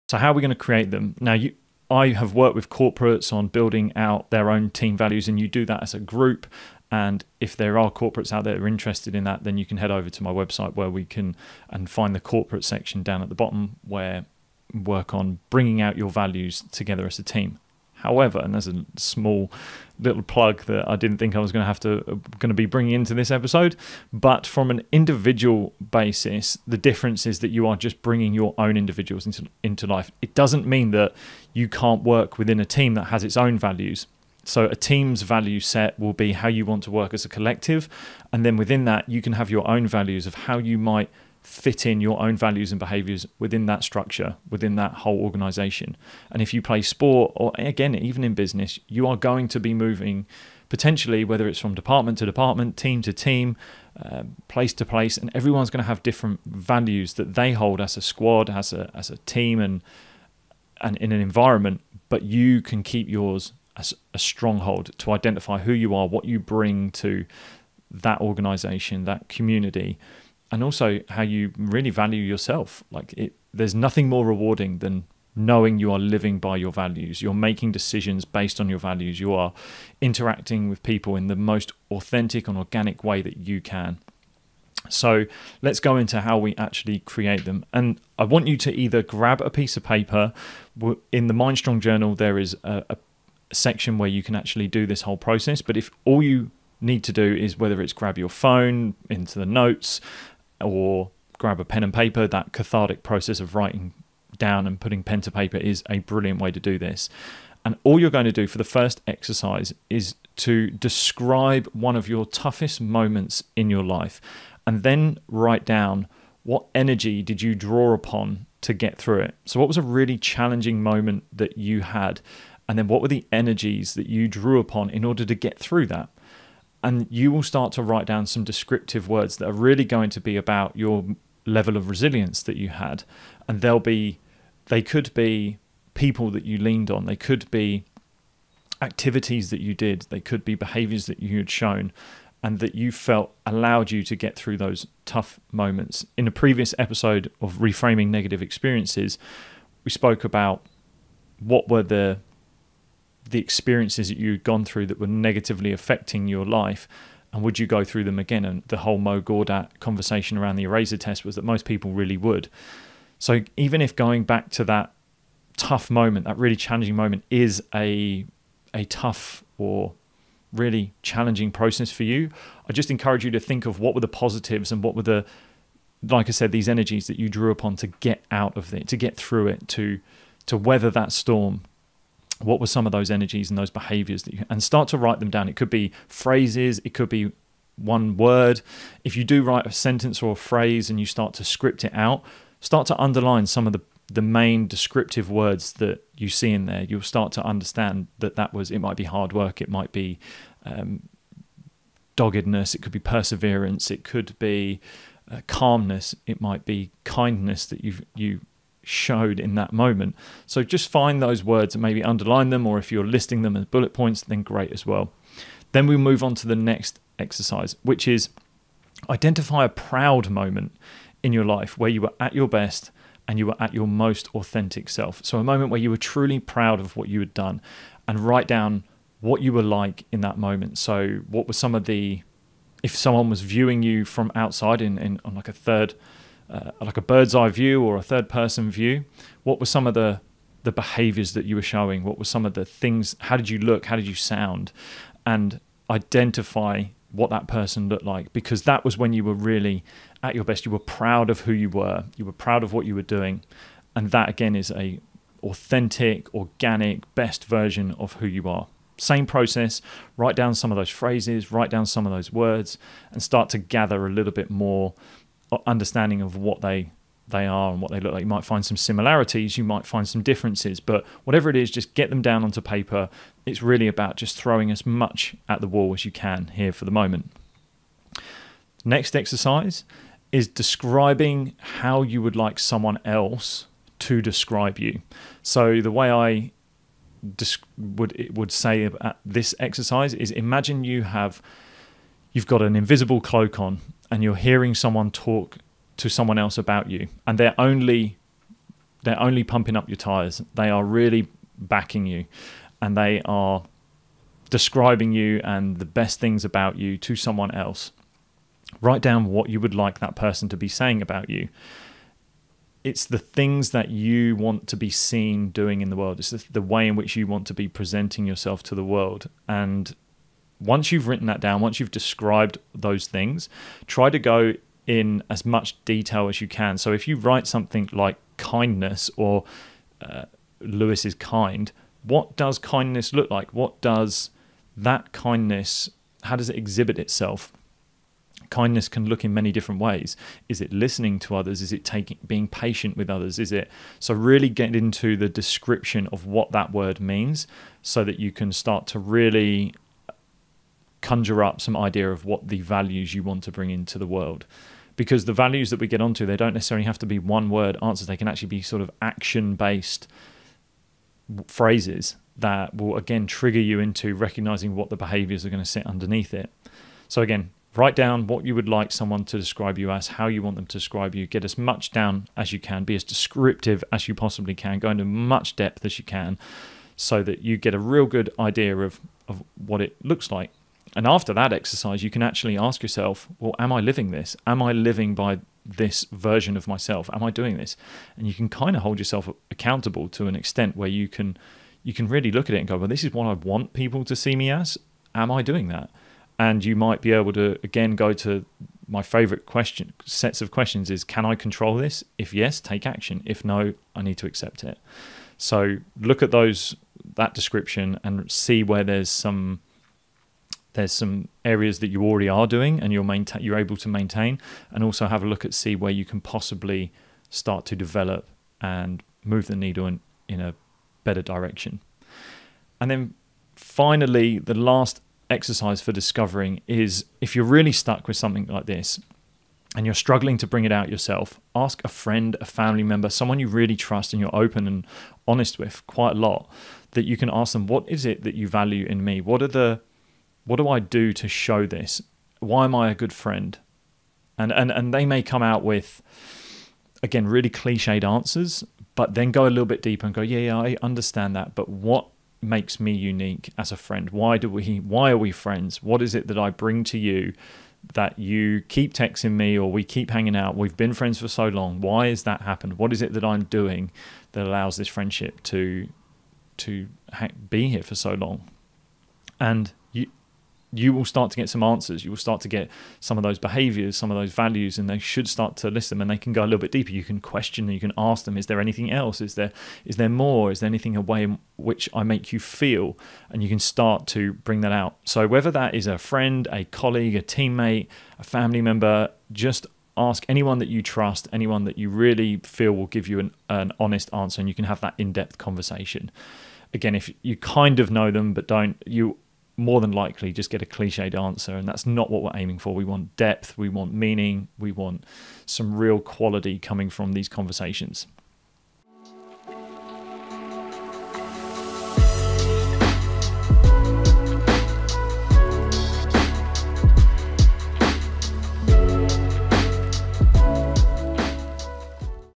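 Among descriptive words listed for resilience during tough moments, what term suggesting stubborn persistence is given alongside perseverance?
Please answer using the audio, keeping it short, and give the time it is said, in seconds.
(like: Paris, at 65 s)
doggedness, at 202 s.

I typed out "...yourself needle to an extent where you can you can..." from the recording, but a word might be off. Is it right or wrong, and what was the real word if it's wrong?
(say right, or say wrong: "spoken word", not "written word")
wrong: "accountable", not "needle".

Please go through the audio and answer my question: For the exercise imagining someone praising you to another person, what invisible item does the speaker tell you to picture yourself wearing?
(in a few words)
invisible cloak.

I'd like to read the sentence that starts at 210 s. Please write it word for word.
So just find those words and maybe underline them, or if you're listing them as bullet points, then great as well.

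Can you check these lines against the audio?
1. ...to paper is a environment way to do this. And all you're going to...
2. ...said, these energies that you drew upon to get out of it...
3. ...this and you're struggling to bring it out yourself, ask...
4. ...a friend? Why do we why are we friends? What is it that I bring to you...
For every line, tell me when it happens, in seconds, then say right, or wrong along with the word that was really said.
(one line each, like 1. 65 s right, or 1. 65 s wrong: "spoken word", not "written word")
1. 105 s wrong: "brilliant", not "environment"
2. 176 s right
3. 428 s right
4. 453 s right.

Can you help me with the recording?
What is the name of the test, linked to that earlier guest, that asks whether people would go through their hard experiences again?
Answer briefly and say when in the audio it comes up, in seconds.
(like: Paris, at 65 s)
eraser test, at 160 s.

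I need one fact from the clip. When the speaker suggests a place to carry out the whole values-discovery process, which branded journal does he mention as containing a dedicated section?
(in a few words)
MindStrong journal.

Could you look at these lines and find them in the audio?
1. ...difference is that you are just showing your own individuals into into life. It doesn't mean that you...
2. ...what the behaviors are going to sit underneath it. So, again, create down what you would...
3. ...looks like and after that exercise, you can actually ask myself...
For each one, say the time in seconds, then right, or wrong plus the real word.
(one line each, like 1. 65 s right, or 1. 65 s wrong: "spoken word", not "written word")
1. 26 s wrong: "bringing", not "showing"
2. 364 s wrong: "write", not "create"
3. 380 s wrong: "yourself", not "myself".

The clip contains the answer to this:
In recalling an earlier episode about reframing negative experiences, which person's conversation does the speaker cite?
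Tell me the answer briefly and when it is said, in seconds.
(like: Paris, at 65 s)
Mo Gawdat, at 158 s.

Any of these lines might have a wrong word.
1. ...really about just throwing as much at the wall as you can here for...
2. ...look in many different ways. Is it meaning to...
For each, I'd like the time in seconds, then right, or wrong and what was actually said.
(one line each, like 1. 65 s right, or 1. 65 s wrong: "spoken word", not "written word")
1. 273 s right
2. 339 s wrong: "listening", not "meaning".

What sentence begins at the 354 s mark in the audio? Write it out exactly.
Because the values that we get onto, they don't necessarily have to be one word answers.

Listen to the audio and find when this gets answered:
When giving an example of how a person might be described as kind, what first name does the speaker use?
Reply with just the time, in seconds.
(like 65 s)
330 s.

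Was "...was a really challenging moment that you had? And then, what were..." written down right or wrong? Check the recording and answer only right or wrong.
right.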